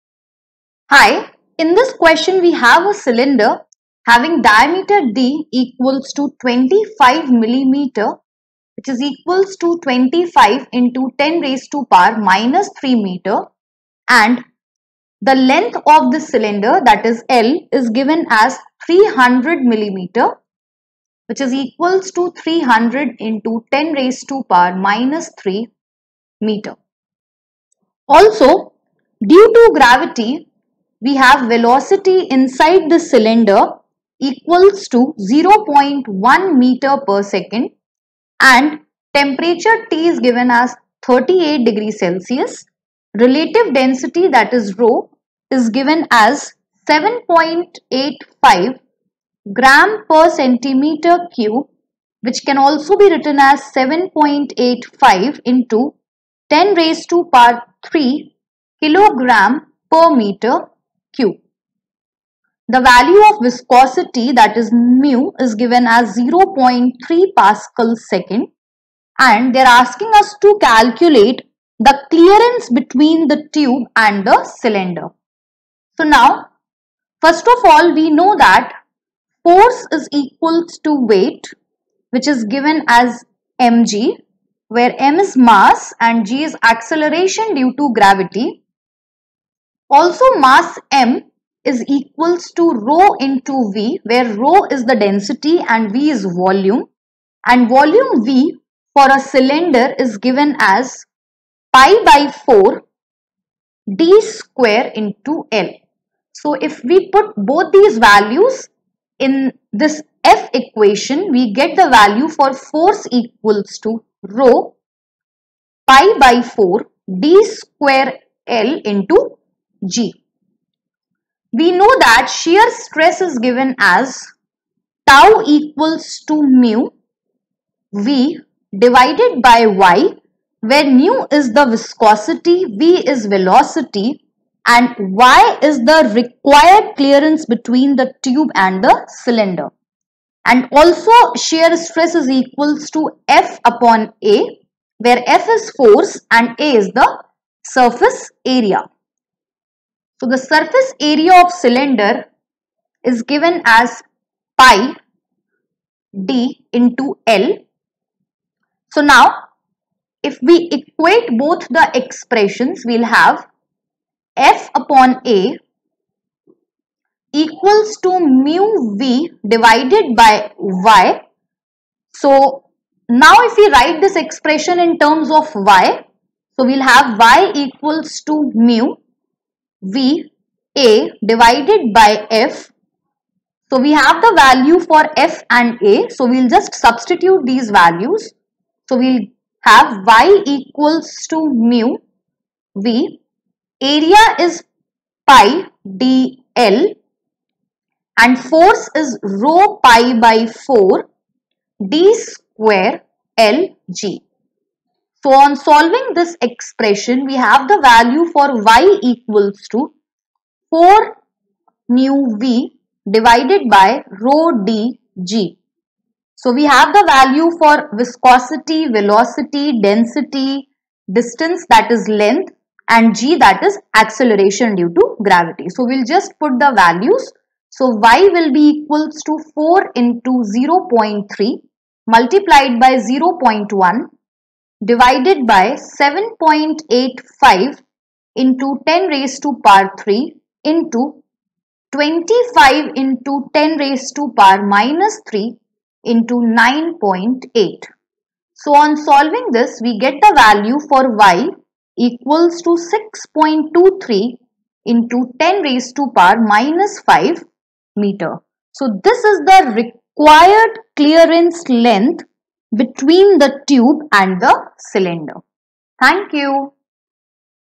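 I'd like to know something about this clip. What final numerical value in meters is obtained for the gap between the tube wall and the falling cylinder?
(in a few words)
6.23 × 10^-5 m.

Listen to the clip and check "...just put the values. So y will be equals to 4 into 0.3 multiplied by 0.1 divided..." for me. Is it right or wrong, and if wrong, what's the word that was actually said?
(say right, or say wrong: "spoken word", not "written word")
right.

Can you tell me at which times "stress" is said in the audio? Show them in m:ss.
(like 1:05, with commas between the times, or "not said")
2:02, 2:21.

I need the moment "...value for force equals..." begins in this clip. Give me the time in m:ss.
1:51.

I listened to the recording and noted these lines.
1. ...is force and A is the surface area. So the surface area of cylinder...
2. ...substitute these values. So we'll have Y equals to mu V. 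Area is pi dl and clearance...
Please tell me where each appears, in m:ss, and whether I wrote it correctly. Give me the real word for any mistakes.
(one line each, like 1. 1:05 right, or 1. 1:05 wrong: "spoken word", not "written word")
1. 2:25 right
2. 3:06 wrong: "force", not "clearance".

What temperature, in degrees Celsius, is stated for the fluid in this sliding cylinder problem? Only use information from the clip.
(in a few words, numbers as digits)
38 degrees Celsius.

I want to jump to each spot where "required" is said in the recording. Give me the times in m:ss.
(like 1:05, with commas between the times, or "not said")
2:16, 4:19.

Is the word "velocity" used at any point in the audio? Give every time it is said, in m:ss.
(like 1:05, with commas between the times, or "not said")
0:31, 2:13, 3:38.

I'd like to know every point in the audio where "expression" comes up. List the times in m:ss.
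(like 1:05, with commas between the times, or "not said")
2:41, 2:54, 3:26.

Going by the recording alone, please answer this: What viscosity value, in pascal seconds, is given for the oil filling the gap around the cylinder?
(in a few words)
0.3 Pa·s.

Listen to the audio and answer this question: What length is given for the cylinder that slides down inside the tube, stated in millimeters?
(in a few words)
300 millimeters.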